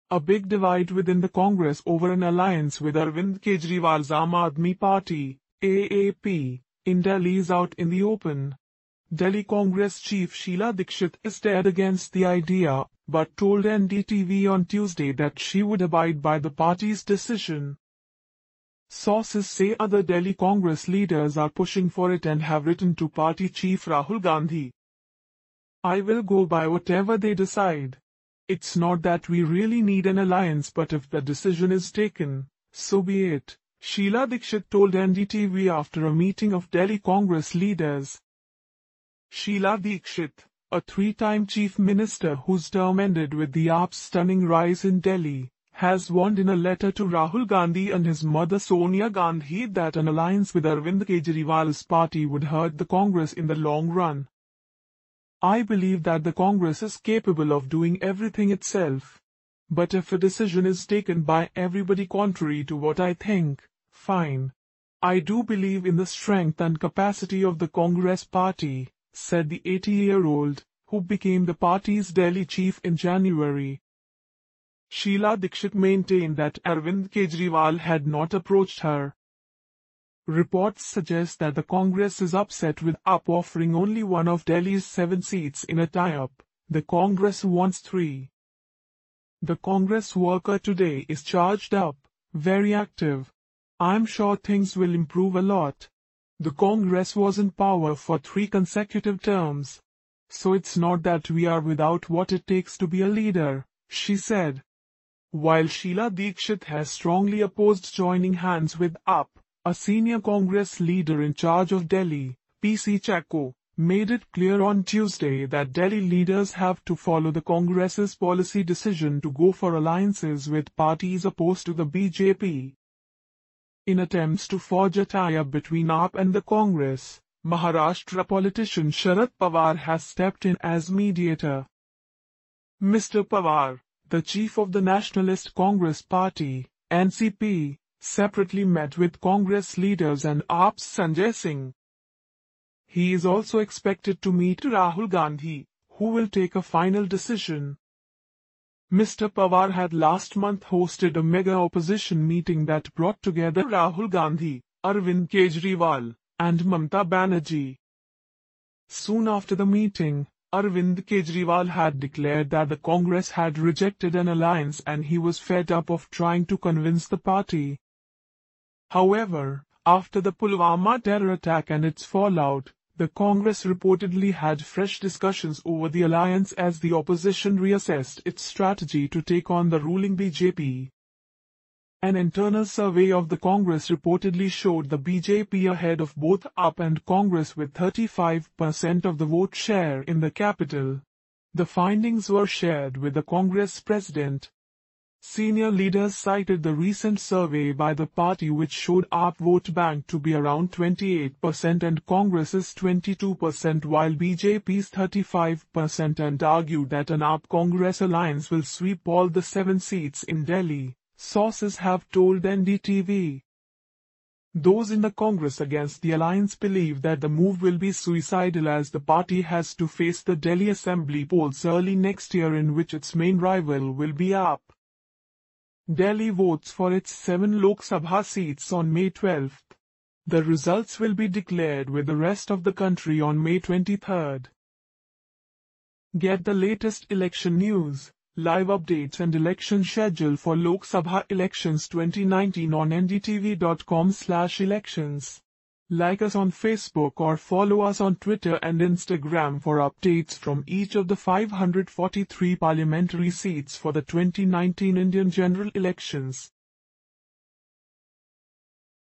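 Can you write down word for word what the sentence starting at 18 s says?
Sources say other Delhi Congress leaders are pushing for it and have written to party chief Rahul Gandhi.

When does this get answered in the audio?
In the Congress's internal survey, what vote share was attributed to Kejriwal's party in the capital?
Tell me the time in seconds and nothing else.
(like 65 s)
200 s.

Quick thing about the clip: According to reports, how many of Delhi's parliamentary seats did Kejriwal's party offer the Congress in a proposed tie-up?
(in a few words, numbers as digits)
1.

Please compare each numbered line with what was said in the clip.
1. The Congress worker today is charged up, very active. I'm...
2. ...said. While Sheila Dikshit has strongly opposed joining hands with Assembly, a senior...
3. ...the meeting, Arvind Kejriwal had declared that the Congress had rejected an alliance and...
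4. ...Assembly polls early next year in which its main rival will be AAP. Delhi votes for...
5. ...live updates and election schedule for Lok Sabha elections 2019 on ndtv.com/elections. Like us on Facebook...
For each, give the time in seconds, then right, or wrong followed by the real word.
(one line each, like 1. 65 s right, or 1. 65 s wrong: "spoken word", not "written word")
1. 89 s right
2. 104 s wrong: "AAP", not "Assembly"
3. 159 s right
4. 220 s right
5. 238 s right.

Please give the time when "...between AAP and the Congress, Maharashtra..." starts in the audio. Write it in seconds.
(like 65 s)
125 s.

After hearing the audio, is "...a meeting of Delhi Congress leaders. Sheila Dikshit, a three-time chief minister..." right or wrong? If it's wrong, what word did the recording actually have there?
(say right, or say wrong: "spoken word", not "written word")
right.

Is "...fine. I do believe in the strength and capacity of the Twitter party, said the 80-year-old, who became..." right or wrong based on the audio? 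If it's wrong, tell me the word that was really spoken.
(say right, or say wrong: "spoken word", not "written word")
wrong: "Congress", not "Twitter".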